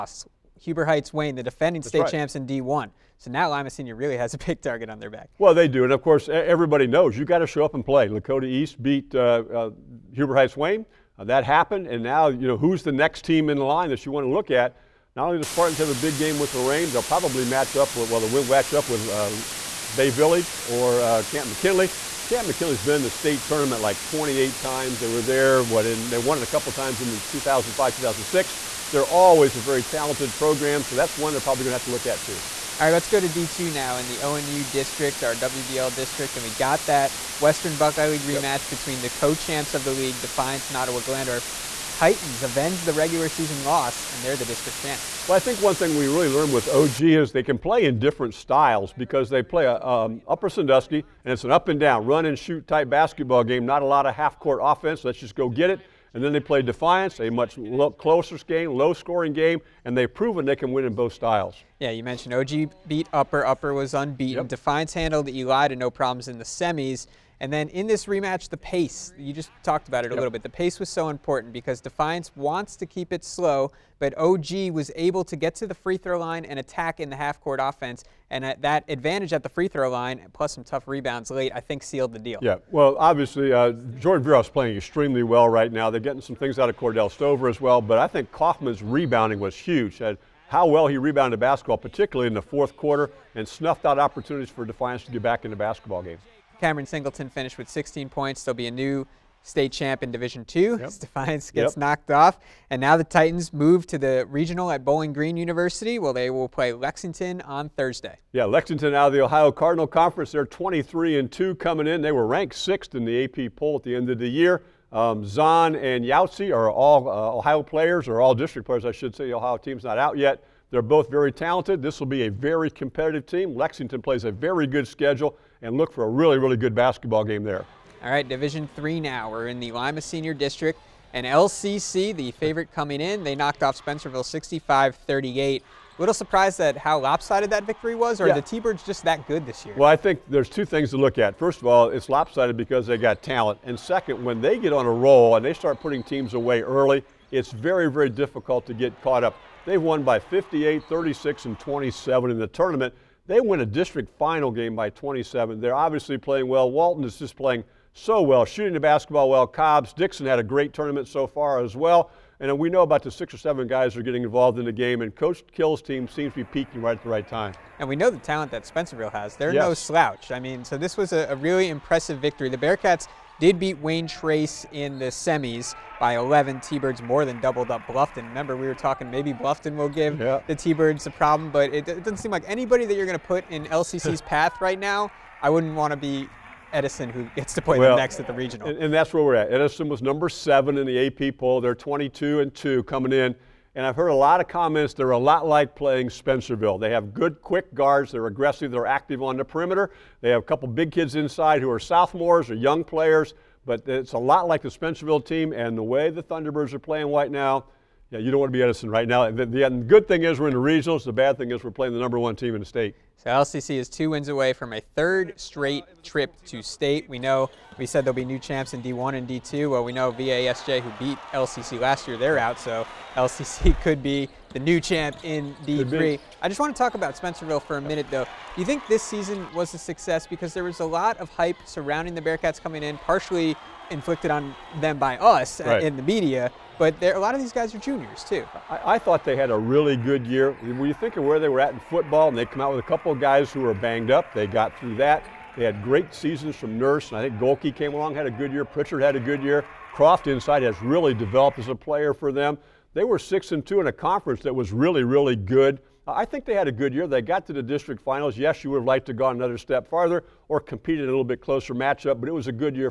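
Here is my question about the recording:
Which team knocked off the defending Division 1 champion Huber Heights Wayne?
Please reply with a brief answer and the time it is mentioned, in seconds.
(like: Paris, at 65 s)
Lakota East, at 8 s.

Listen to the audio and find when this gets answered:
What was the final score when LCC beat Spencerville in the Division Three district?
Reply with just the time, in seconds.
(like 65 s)
134 s.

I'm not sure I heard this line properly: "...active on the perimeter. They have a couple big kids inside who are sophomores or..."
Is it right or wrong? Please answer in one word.
right.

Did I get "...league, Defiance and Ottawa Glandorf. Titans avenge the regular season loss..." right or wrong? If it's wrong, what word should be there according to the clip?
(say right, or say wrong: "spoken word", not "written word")
right.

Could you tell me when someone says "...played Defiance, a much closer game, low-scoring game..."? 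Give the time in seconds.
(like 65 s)
56 s.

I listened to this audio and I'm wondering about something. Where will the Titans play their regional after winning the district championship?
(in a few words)
Bowling Green University.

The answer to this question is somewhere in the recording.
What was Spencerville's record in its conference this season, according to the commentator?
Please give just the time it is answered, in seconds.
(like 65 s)
253 s.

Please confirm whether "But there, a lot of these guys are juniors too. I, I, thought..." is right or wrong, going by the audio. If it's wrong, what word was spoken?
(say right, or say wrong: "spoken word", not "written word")
right.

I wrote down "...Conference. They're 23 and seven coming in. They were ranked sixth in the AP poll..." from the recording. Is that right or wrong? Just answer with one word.
wrong.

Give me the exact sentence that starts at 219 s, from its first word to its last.
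Well, we know VASJ, who beat LCC last year, they're out.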